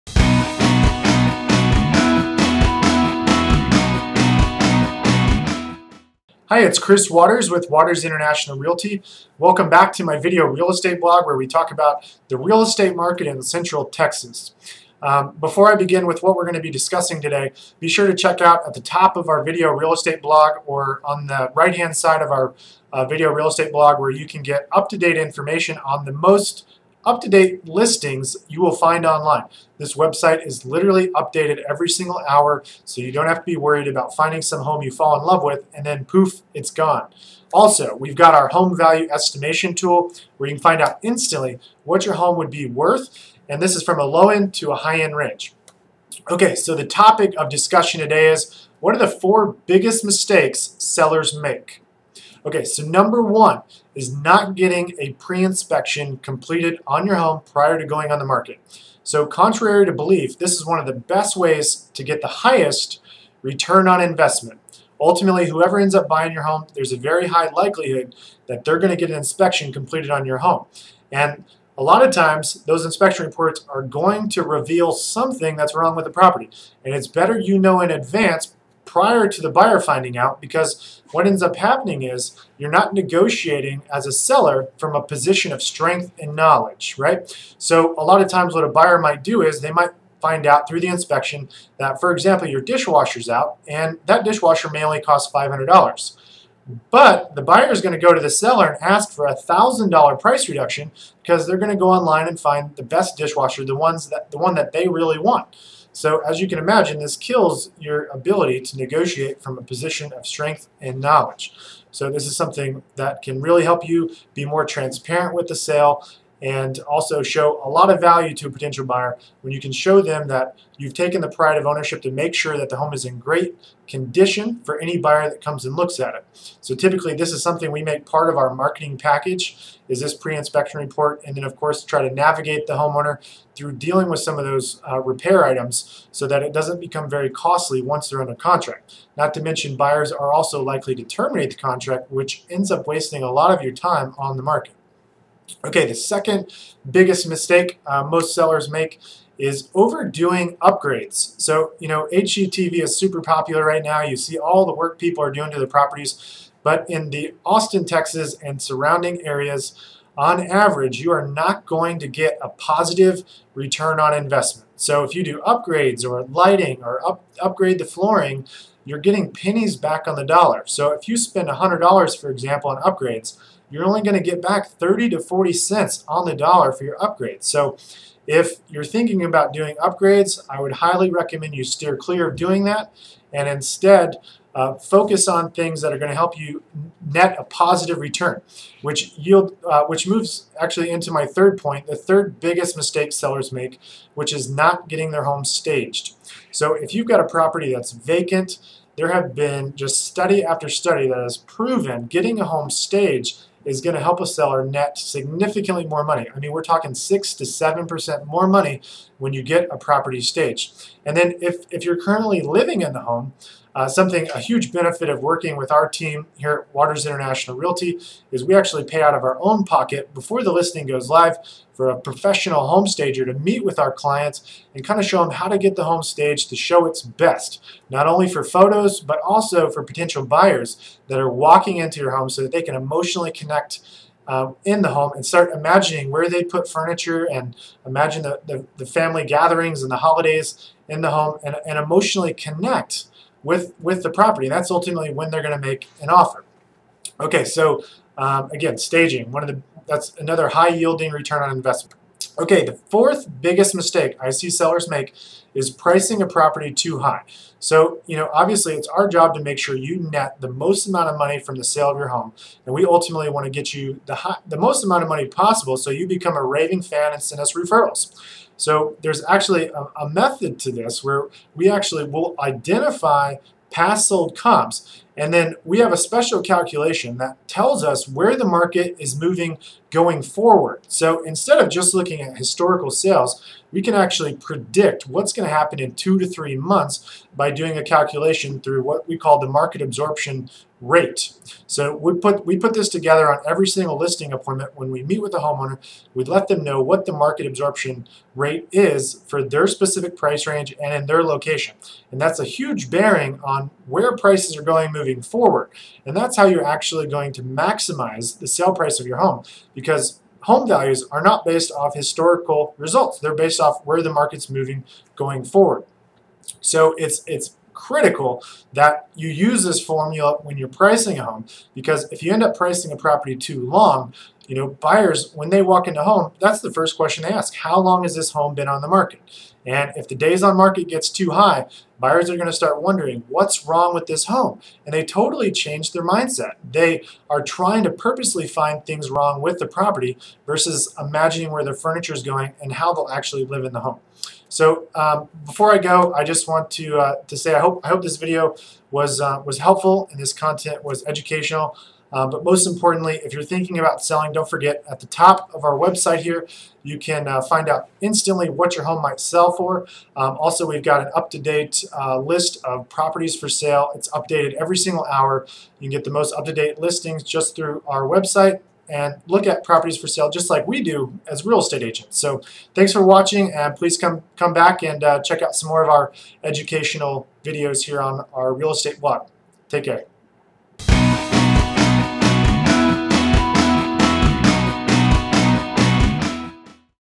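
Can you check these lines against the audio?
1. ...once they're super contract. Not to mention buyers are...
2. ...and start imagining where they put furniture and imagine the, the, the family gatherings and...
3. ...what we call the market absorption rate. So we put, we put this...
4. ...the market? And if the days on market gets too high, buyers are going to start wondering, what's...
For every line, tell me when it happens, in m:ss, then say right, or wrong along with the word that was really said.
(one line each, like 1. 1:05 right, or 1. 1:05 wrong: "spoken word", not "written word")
1. 2:17 wrong: "under", not "super"
2. 3:55 right
3. 4:48 right
4. 5:28 right.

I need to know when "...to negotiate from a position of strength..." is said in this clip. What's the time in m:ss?
1:48.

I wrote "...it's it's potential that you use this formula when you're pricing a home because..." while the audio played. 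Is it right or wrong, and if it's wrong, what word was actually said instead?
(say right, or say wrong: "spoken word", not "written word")
wrong: "critical", not "potential".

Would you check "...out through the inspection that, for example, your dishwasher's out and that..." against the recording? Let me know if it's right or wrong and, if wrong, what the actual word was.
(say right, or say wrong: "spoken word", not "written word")
right.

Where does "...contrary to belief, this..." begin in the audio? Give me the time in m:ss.
0:59.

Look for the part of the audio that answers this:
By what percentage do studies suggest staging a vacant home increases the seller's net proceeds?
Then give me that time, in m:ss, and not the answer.
3:26.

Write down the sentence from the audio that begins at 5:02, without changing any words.
And that's a huge bearing on where prices are going moving forward.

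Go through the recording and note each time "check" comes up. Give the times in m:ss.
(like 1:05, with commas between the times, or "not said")
0:18, 6:15.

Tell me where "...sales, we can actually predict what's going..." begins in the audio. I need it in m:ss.
4:42.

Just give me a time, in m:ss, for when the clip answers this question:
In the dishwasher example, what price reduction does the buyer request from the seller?
1:39.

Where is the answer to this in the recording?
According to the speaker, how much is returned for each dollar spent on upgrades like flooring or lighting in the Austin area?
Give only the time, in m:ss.
2:54.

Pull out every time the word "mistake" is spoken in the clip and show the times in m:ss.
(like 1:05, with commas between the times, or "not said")
0:50, 2:27, 3:12, 4:13.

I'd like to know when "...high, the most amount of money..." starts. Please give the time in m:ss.
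4:24.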